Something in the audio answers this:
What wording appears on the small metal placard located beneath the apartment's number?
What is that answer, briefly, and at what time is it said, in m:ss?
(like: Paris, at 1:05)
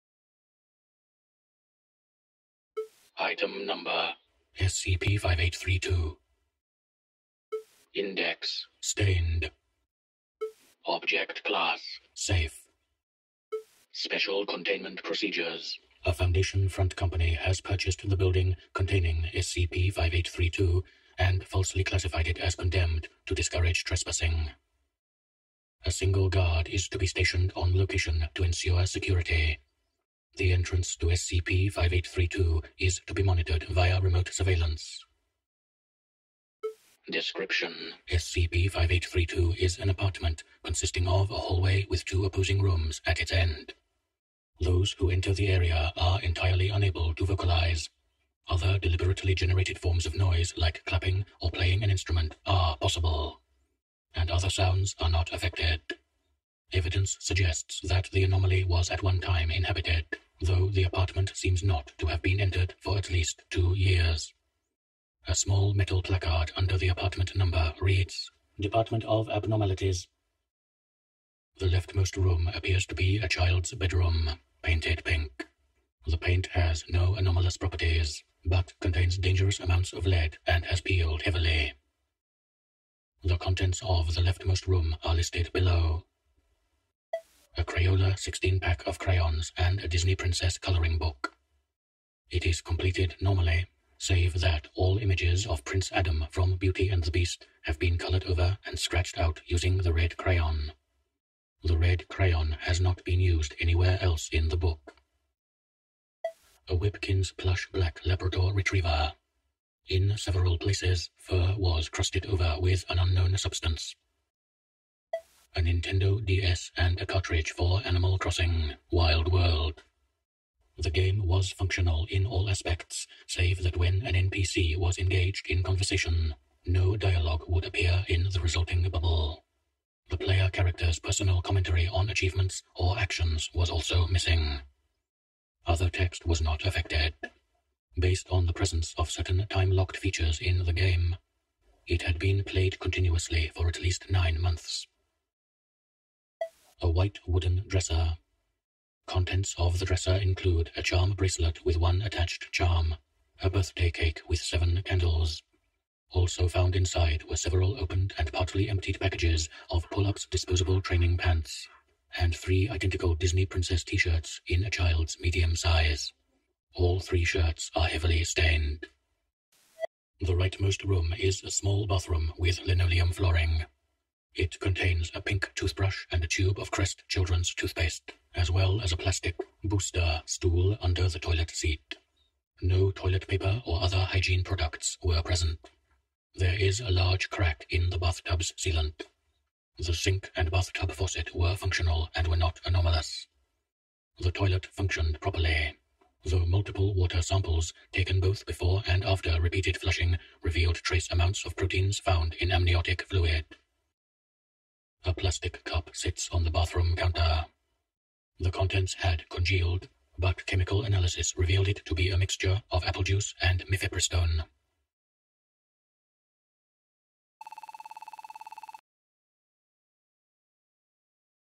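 Department of Abnormalities, at 1:08.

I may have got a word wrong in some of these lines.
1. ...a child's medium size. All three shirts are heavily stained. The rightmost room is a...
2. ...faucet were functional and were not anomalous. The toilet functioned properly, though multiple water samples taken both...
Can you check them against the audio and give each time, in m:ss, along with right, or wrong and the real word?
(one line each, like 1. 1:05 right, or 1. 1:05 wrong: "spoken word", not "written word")
1. 2:44 right
2. 3:10 right.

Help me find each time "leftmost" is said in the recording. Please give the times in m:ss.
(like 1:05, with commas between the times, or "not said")
1:11, 1:24.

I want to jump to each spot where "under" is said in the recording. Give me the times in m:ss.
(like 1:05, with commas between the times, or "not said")
1:06, 3:00.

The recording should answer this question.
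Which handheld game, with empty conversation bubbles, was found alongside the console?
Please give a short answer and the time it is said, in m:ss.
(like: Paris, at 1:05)
Animal Crossing Wild World, at 1:57.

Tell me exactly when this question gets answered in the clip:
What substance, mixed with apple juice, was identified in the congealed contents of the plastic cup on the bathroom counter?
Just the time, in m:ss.
3:33.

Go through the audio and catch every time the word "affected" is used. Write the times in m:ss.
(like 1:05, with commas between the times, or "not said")
0:55, 2:16.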